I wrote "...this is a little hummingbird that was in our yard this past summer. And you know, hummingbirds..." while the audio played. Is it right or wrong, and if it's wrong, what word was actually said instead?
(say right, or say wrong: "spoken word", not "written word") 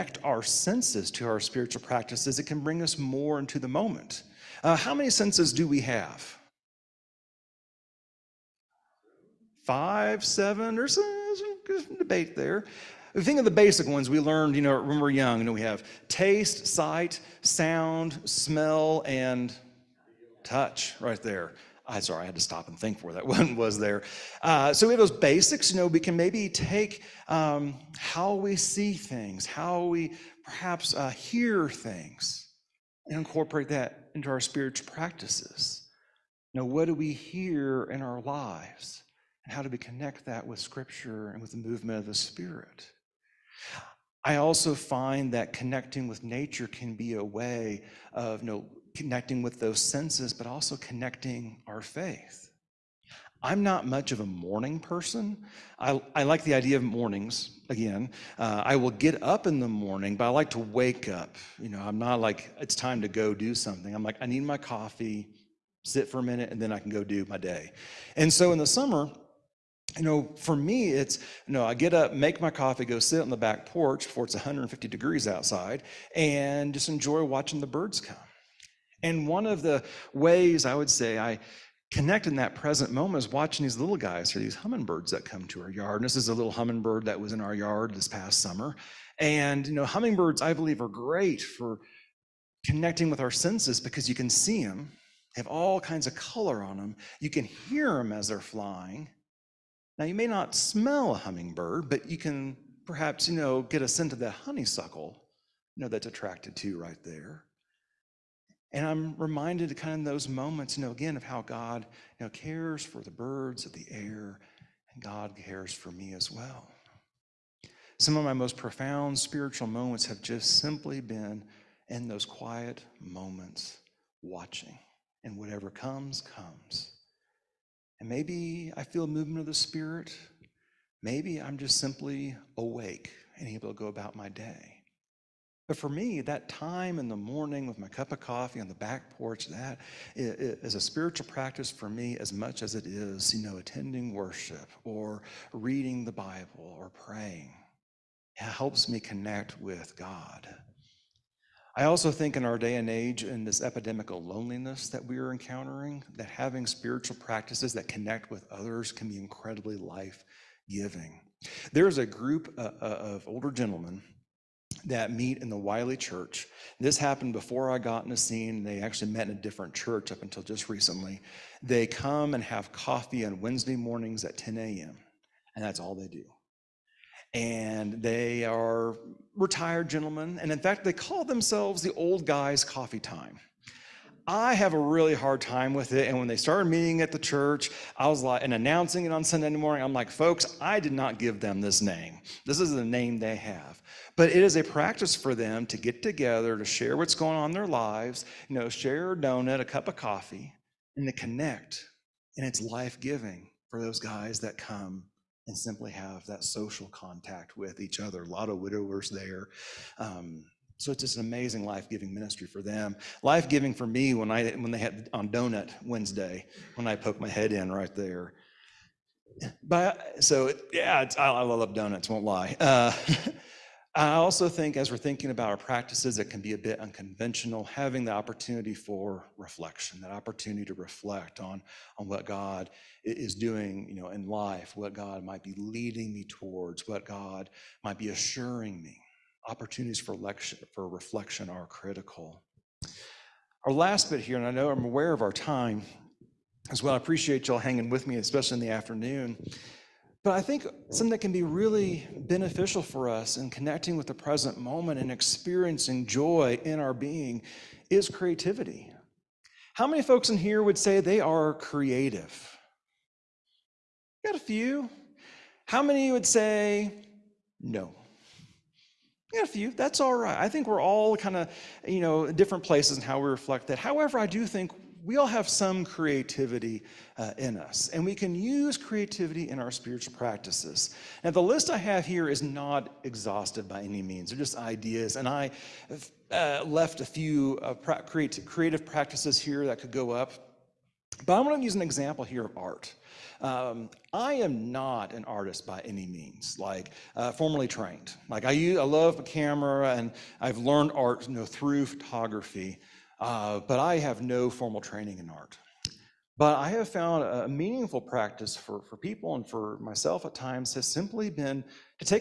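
right.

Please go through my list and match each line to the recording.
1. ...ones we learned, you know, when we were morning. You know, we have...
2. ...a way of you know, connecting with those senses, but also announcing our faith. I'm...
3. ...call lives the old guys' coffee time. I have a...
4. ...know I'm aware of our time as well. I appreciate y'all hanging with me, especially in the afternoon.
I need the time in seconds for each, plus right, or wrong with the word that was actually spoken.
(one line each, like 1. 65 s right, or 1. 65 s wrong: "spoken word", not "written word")
1. 13 s wrong: "young", not "morning"
2. 47 s wrong: "connecting", not "announcing"
3. 180 s wrong: "themselves", not "lives"
4. 244 s right.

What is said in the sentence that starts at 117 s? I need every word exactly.
Some of my most profound spiritual moments have just simply been in those quiet moments, watching, and whatever comes, comes.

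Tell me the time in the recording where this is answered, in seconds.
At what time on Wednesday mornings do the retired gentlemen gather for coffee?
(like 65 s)
174 s.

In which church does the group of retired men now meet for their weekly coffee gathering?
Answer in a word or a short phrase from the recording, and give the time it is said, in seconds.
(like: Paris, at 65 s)
Wiley Church, at 165 s.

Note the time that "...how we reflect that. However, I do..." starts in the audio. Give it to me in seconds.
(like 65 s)
273 s.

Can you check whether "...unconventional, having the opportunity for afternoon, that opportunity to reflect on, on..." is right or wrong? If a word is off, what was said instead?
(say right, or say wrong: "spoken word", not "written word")
wrong: "reflection", not "afternoon".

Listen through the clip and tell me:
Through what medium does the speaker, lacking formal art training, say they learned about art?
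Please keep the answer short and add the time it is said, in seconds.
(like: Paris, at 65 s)
Photography, at 301 s.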